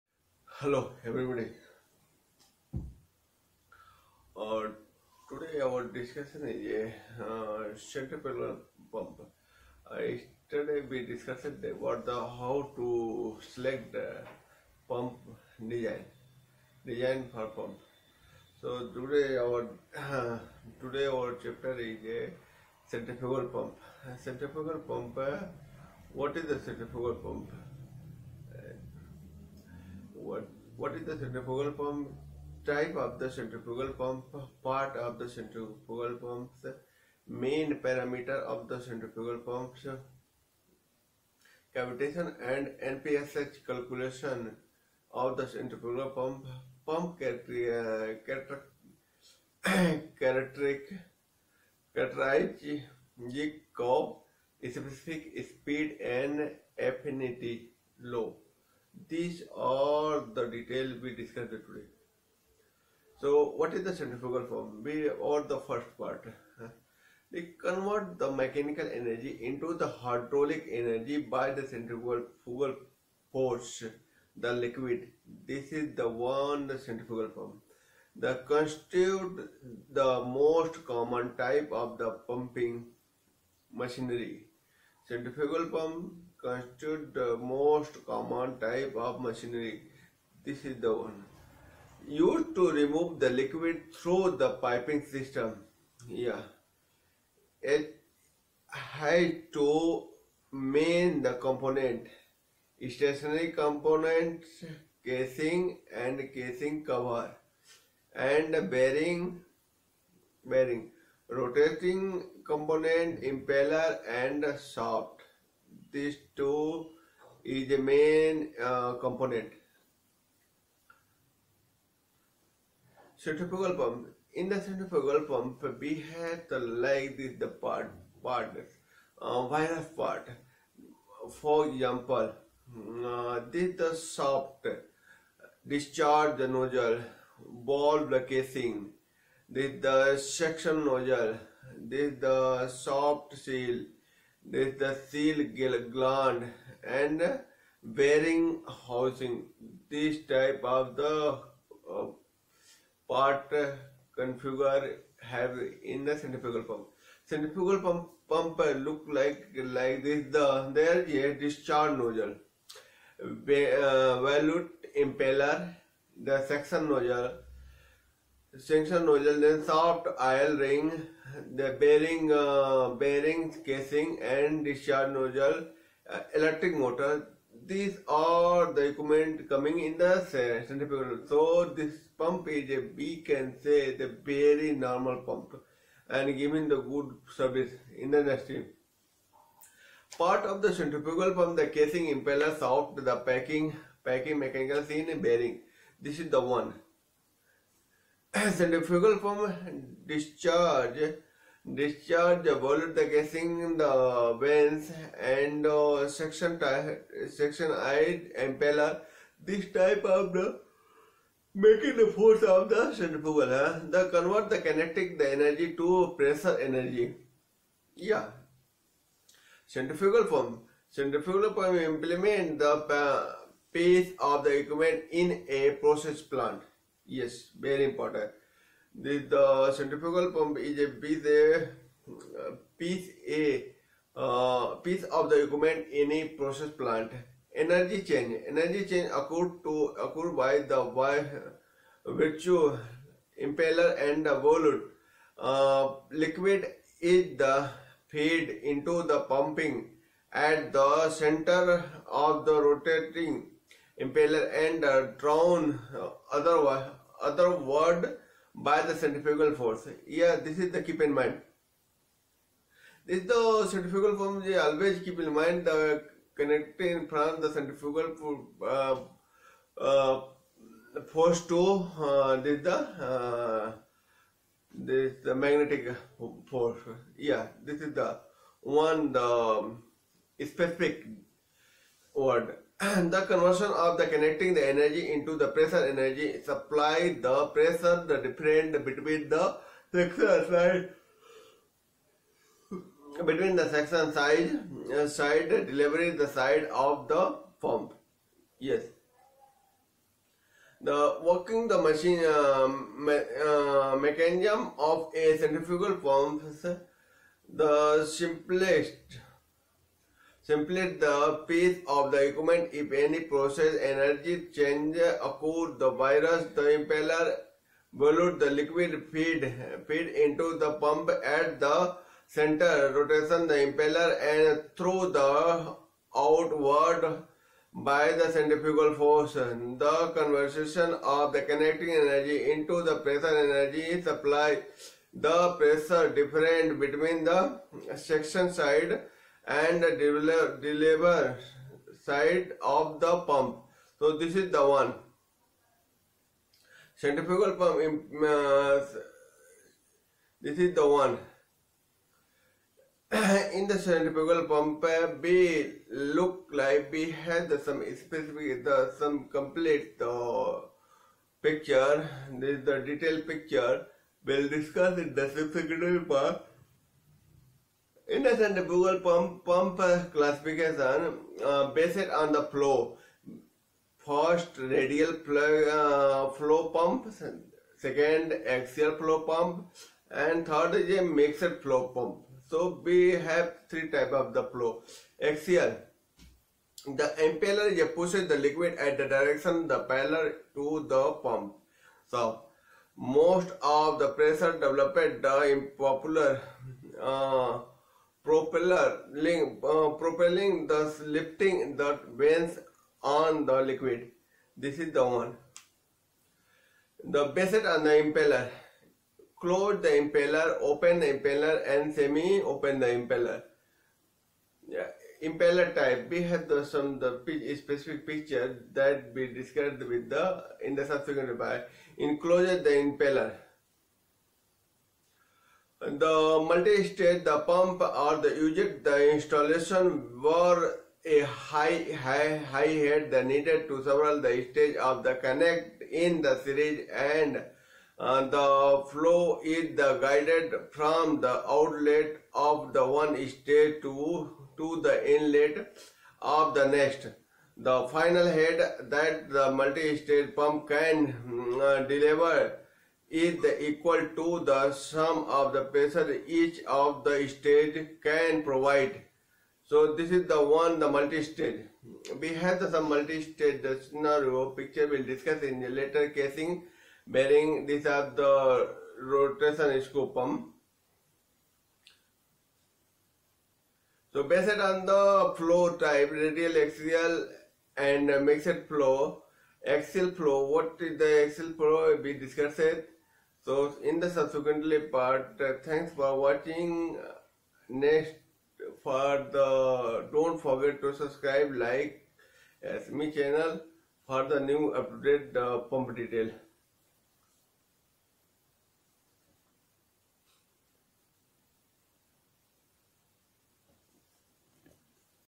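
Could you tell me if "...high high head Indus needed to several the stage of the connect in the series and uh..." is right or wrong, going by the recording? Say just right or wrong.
wrong.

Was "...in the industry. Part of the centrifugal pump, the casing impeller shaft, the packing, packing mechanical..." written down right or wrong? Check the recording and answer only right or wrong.
right.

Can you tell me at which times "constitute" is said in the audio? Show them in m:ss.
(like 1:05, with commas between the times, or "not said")
1:18, 1:26.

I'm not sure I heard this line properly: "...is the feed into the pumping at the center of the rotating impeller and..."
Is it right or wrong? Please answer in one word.
right.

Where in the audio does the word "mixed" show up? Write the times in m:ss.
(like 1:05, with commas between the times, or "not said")
6:21, 7:58.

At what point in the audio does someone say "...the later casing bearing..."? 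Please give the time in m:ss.
7:45.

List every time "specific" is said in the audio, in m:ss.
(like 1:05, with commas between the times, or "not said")
0:54, 4:40, 5:57, 6:57.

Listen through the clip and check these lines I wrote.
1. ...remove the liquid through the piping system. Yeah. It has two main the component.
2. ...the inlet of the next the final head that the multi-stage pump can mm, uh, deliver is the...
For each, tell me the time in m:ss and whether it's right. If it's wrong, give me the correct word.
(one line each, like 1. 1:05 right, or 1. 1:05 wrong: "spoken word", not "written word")
1. 1:32 right
2. 7:24 right.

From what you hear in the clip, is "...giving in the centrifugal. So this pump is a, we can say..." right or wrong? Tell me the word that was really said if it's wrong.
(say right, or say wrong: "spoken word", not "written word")
wrong: "coming", not "giving".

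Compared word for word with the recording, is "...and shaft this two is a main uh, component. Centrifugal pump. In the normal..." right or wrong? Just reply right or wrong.
wrong.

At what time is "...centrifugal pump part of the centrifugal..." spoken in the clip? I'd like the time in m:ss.
0:33.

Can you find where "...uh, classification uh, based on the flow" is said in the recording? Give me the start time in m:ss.
6:09.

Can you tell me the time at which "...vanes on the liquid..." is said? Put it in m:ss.
6:42.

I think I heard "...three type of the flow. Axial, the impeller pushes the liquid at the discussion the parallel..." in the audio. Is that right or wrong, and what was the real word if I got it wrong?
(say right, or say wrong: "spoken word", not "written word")
wrong: "direction", not "discussion".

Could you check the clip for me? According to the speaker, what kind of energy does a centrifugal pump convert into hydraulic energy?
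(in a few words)
Mechanical energy.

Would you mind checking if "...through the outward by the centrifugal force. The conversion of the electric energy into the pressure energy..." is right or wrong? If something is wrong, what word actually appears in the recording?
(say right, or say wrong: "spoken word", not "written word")
wrong: "kinetic", not "electric".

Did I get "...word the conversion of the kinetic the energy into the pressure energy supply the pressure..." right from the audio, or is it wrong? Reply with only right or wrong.
right.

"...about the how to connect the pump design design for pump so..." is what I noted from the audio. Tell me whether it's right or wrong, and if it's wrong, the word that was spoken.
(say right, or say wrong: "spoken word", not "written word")
wrong: "select", not "connect".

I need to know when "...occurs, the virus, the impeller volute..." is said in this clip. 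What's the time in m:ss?
5:14.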